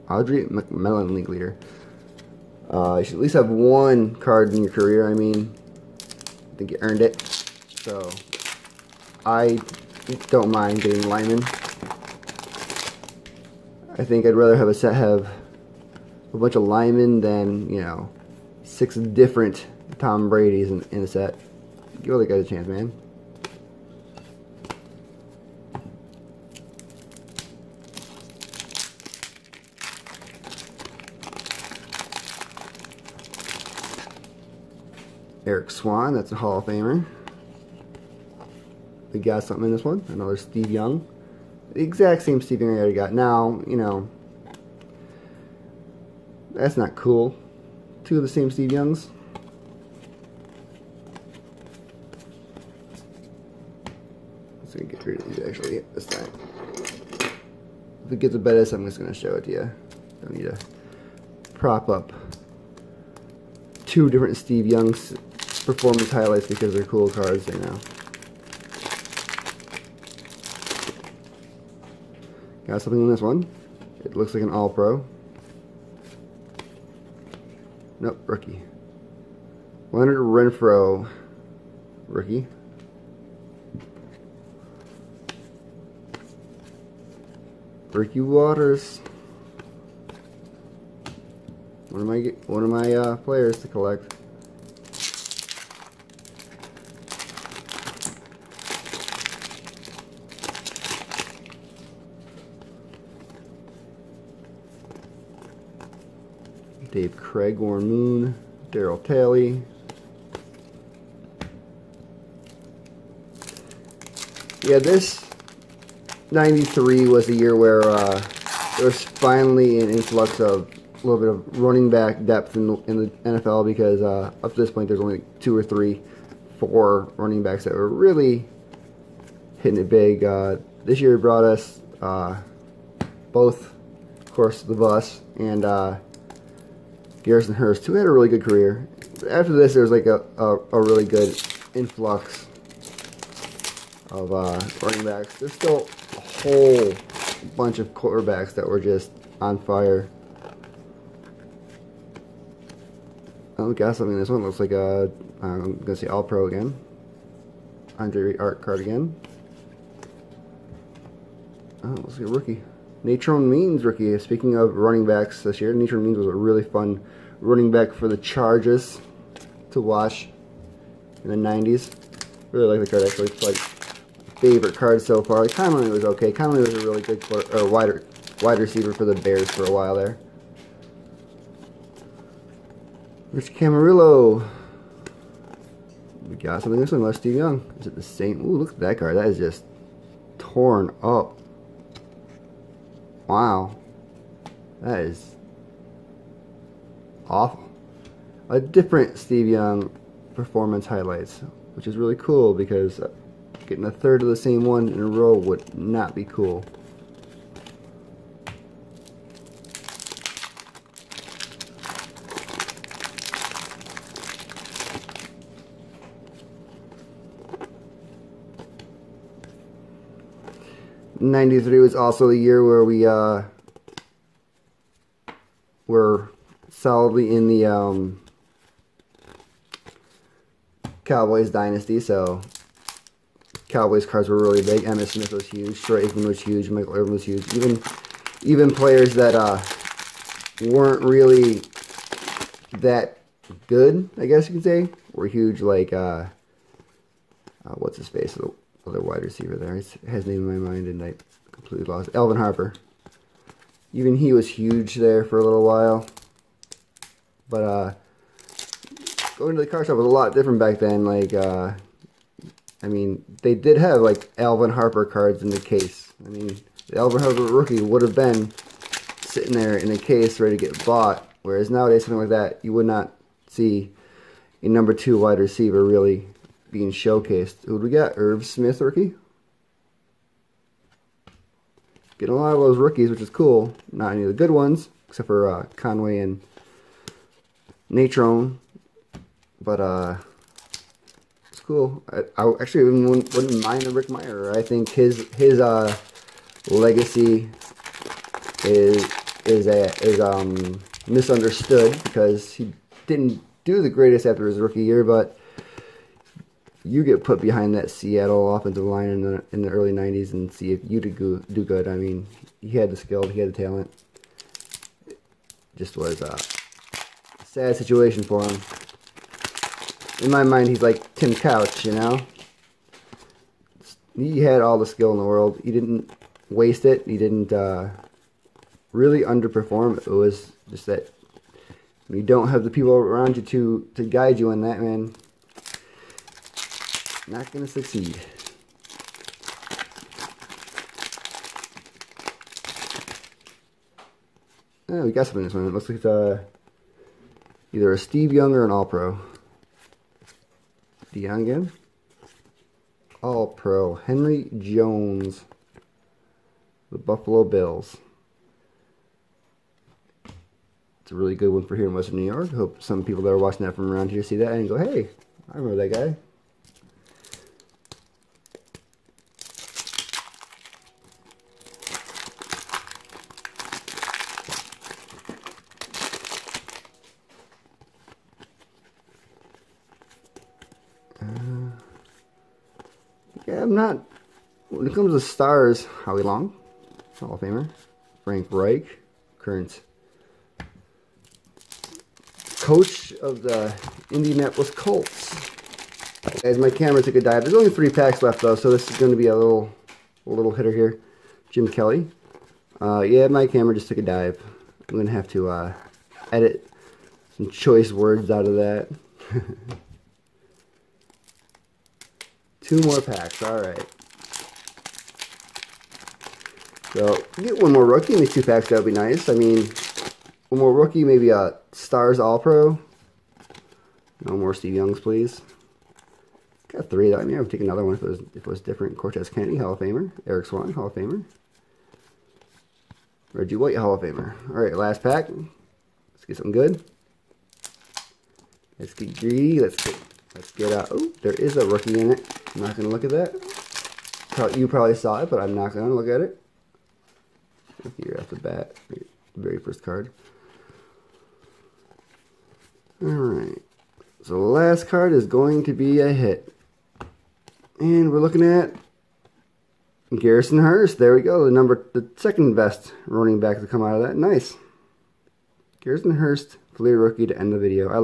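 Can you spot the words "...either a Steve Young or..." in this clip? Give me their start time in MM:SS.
05:47.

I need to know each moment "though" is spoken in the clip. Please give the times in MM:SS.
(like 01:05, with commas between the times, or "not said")
06:38.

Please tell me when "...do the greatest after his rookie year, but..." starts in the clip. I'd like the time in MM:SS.
05:03.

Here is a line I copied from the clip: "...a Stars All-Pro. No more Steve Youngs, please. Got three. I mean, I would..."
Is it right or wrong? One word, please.
right.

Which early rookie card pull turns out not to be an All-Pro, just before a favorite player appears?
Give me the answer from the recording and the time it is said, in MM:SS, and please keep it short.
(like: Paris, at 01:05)
Leonard Renfro, at 01:19.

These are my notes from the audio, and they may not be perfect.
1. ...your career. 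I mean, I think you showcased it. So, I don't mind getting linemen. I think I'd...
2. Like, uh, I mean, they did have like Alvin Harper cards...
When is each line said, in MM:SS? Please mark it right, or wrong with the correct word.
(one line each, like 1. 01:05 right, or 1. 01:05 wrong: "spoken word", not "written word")
1. 00:04 wrong: "earned", not "showcased"
2. 04:21 right.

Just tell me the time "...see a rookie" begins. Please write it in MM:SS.
02:42.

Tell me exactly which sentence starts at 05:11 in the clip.
I mean, he had the skill, he had the talent.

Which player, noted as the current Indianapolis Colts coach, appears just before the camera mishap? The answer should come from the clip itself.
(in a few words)
Frank Reich.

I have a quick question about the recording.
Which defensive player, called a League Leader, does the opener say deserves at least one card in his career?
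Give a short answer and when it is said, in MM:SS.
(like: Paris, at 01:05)
Audray McMillian, at 00:00.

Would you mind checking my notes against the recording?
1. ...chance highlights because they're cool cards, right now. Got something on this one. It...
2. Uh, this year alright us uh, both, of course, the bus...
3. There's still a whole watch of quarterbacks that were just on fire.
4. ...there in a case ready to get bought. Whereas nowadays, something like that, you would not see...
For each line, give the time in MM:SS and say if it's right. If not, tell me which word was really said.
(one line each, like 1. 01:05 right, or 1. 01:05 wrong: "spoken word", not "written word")
1. 01:05 wrong: "performance", not "chance"
2. 02:10 wrong: "brought", not "alright"
3. 02:25 wrong: "bunch", not "watch"
4. 04:29 right.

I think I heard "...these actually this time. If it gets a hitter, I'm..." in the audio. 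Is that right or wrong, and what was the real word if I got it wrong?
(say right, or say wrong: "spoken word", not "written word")
wrong: "better", not "hitter".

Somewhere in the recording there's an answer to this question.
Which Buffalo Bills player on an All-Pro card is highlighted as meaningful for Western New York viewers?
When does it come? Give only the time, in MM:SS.
05:53.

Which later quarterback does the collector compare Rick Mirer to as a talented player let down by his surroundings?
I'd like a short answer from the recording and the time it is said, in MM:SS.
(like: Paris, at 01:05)
Tim Couch, at 05:21.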